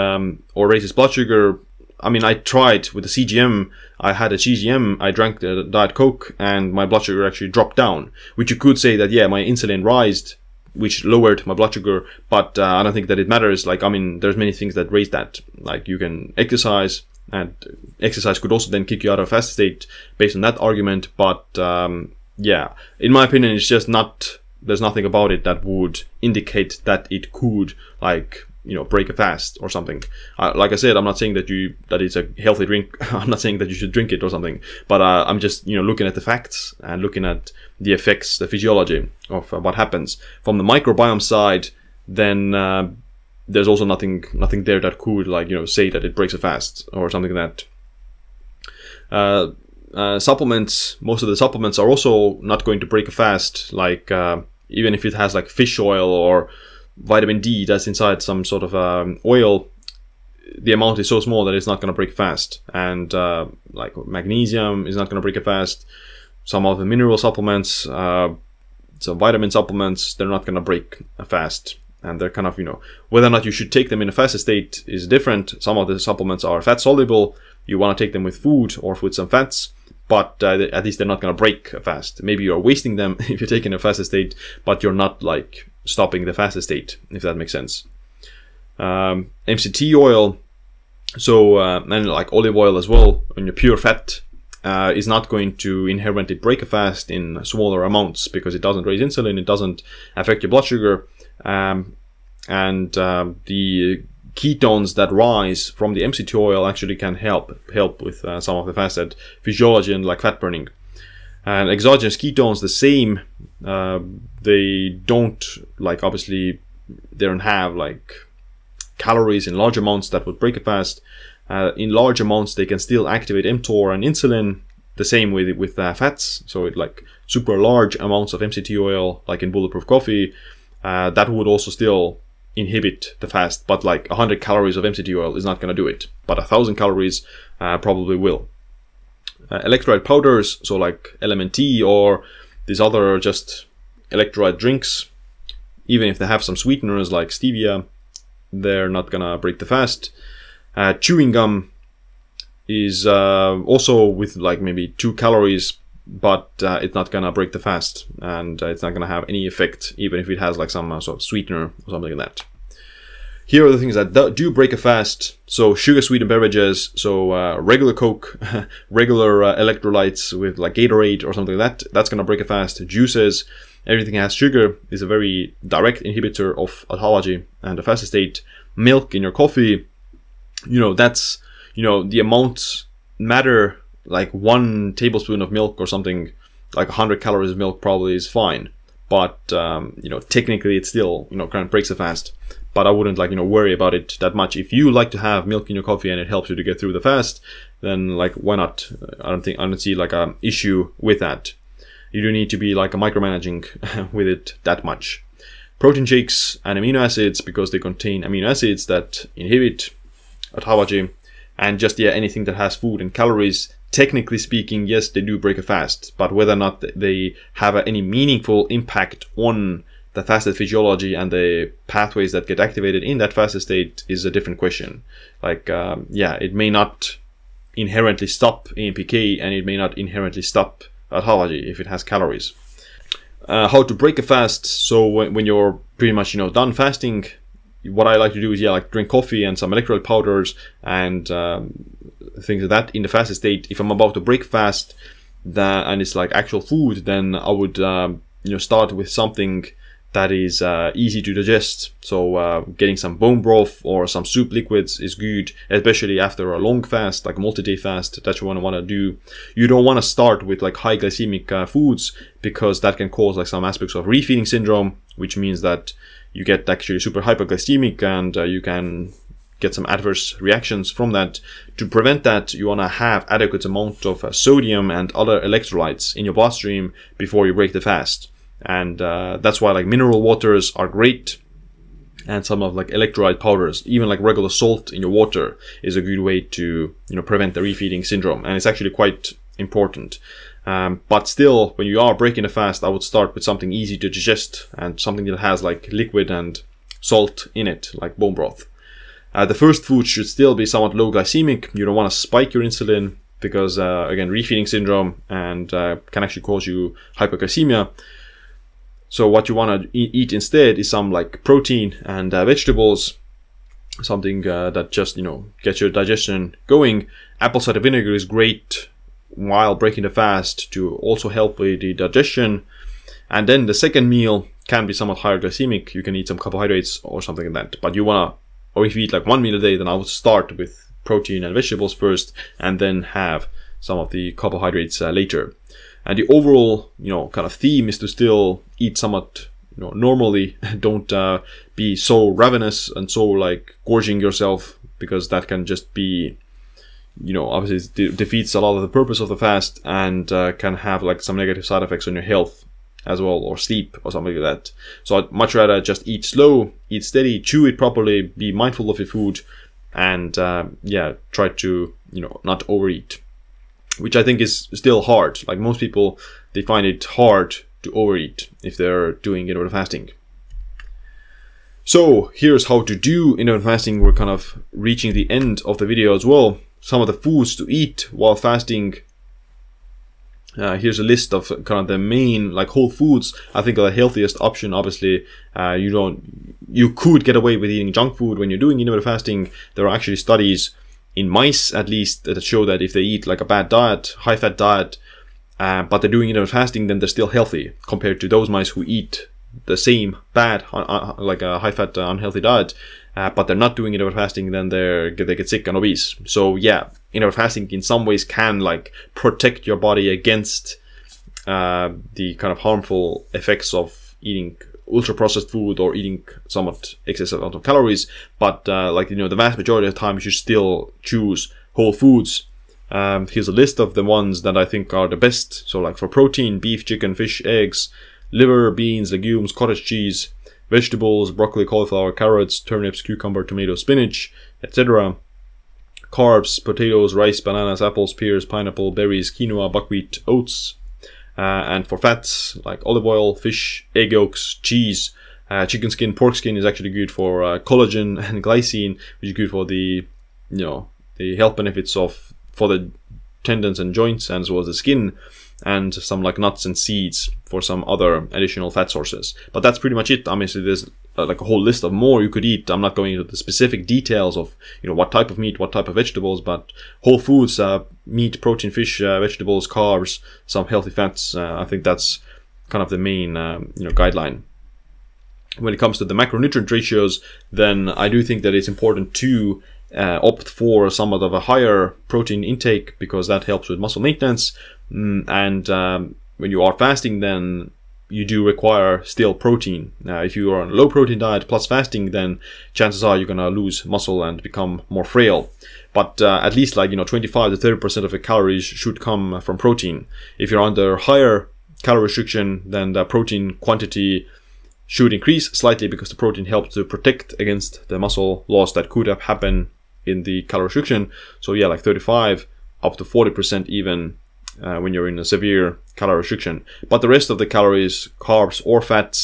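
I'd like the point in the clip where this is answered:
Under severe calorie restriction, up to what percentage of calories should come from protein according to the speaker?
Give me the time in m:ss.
8:33.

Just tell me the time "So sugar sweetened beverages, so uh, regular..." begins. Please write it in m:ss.
2:45.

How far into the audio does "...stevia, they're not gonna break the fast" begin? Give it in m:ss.
2:27.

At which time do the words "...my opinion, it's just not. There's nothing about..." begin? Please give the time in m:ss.
0:23.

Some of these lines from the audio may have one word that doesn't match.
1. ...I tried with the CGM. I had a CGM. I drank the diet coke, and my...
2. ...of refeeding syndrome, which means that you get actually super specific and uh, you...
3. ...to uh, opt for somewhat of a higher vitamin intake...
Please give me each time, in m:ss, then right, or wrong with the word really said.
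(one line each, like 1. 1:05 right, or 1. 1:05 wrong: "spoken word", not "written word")
1. 0:02 right
2. 4:23 wrong: "hyperglycemic", not "specific"
3. 7:59 wrong: "protein", not "vitamin".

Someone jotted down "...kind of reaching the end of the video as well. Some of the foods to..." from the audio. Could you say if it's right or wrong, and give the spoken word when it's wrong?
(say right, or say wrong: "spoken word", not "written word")
right.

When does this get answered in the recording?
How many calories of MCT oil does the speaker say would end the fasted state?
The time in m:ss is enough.
2:16.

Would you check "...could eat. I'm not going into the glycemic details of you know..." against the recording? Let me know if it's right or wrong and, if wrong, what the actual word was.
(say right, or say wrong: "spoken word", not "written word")
wrong: "specific", not "glycemic".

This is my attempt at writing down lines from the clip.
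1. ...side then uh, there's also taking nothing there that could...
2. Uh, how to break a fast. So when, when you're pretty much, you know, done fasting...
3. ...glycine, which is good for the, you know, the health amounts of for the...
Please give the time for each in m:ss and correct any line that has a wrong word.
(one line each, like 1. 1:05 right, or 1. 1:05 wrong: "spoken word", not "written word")
1. 0:41 wrong: "nothing", not "taking"
2. 3:53 right
3. 7:28 wrong: "benefits", not "amounts".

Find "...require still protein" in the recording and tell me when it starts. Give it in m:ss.
8:08.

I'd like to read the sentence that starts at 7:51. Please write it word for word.
Uh, I think that's kind of the main um, you know guideline.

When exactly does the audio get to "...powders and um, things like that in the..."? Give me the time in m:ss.
4:00.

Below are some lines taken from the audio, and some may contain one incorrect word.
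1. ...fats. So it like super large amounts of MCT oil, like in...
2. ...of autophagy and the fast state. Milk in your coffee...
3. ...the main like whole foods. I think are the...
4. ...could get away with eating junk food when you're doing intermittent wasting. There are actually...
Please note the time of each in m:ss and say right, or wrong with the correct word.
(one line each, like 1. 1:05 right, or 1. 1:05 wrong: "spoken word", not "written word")
1. 2:05 right
2. 2:56 right
3. 6:21 right
4. 6:26 wrong: "fasting", not "wasting".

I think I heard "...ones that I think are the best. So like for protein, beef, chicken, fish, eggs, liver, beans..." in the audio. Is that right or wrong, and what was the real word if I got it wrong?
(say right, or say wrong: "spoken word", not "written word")
right.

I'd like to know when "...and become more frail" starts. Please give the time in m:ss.
8:14.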